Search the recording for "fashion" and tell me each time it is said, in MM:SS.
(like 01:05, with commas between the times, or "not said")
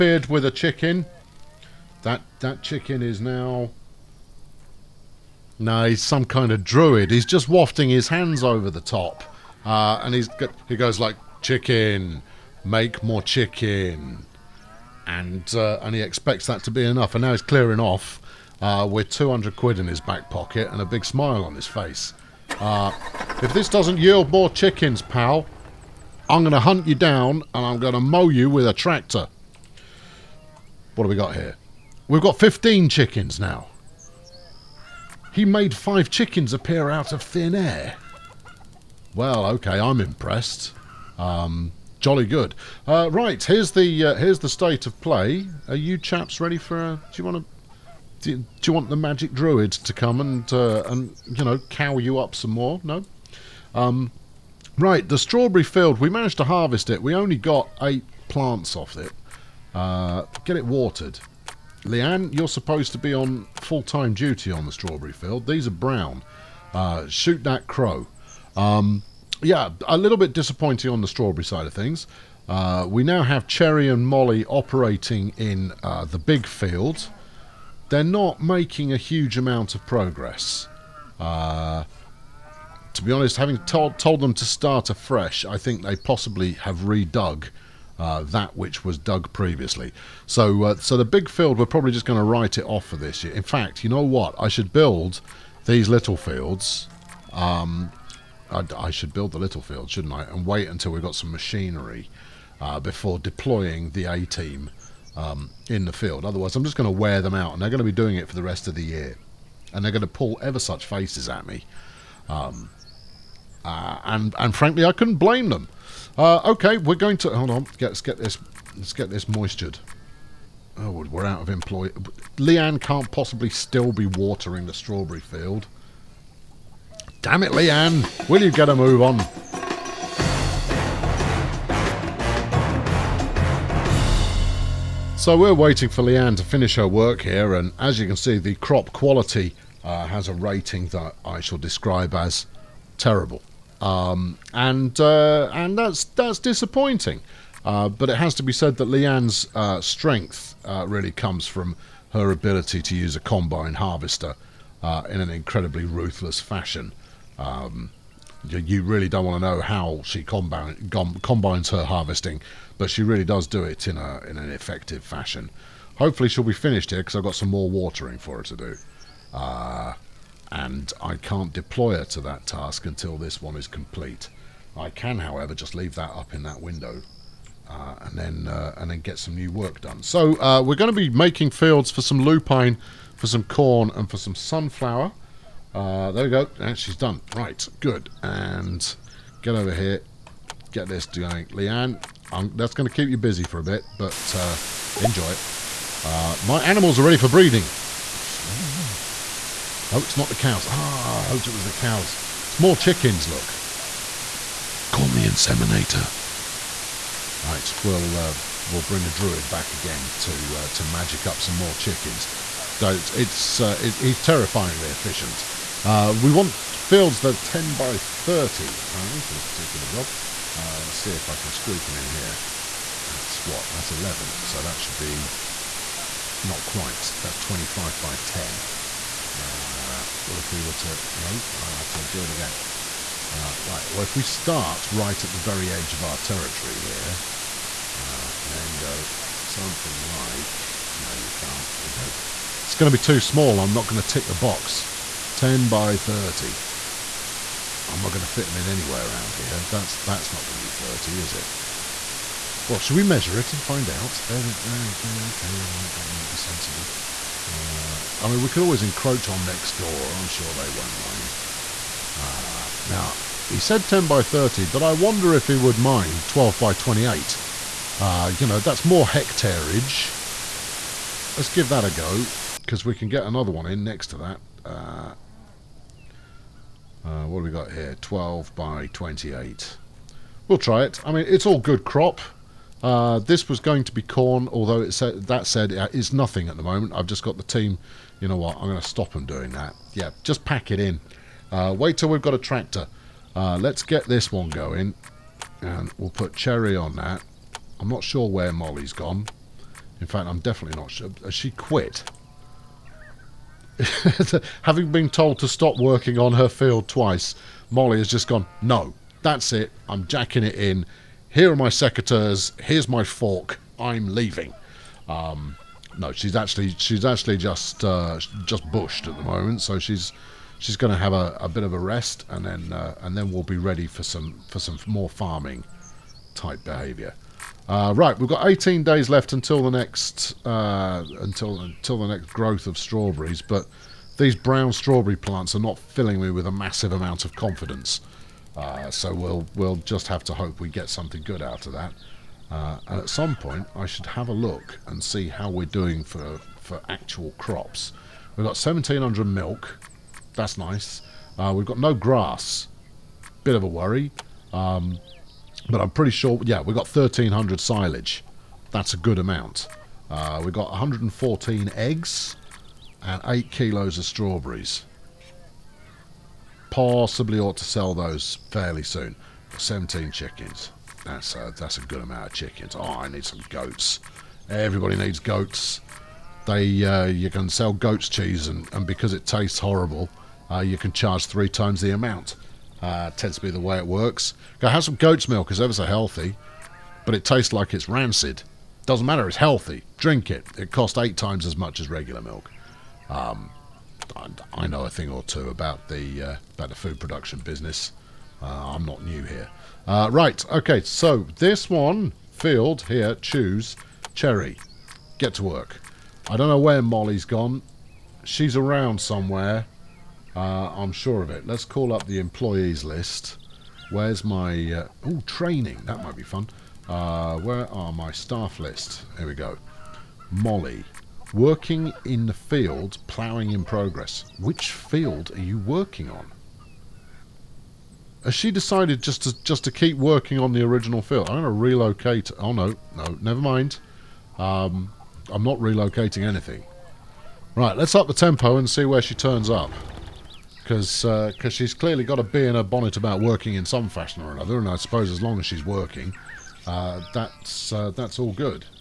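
02:36, 02:45, 07:23.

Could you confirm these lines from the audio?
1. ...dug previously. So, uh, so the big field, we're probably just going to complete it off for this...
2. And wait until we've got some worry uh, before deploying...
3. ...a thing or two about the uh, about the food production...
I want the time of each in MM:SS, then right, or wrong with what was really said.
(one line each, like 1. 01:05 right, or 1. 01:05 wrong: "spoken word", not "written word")
1. 01:28 wrong: "write", not "complete"
2. 01:40 wrong: "machinery", not "worry"
3. 06:34 right.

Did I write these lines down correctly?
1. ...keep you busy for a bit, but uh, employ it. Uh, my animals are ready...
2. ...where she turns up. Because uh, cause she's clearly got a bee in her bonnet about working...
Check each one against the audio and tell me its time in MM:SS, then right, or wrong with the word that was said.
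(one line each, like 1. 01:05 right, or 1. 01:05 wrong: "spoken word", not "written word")
1. 03:12 wrong: "enjoy", not "employ"
2. 07:18 right.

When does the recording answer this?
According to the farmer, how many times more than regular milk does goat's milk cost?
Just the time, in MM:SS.
06:30.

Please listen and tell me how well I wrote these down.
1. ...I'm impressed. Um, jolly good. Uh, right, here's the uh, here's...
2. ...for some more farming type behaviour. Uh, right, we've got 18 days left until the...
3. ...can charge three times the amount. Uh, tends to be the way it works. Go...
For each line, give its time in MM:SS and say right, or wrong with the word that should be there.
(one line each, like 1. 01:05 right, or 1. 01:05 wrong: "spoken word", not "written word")
1. 00:39 right
2. 05:24 right
3. 06:20 right.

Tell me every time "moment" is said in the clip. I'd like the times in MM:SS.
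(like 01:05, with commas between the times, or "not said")
04:46, 05:19.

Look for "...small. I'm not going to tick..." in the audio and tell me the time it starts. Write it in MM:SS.
04:03.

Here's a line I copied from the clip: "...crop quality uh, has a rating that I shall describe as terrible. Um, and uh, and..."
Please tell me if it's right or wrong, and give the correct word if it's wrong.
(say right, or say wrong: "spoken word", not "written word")
right.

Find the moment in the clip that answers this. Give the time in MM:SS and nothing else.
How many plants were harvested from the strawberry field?
00:57.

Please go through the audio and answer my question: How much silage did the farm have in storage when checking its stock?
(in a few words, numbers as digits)
1,300.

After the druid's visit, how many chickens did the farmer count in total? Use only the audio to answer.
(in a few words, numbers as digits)
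15.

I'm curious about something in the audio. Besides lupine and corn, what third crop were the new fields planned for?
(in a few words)
Sunflower.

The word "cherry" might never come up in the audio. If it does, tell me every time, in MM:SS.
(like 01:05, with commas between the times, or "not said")
01:13, 04:56, 06:44.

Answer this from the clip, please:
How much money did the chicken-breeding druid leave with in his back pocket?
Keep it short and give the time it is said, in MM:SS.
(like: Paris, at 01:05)
200 quid, at 00:19.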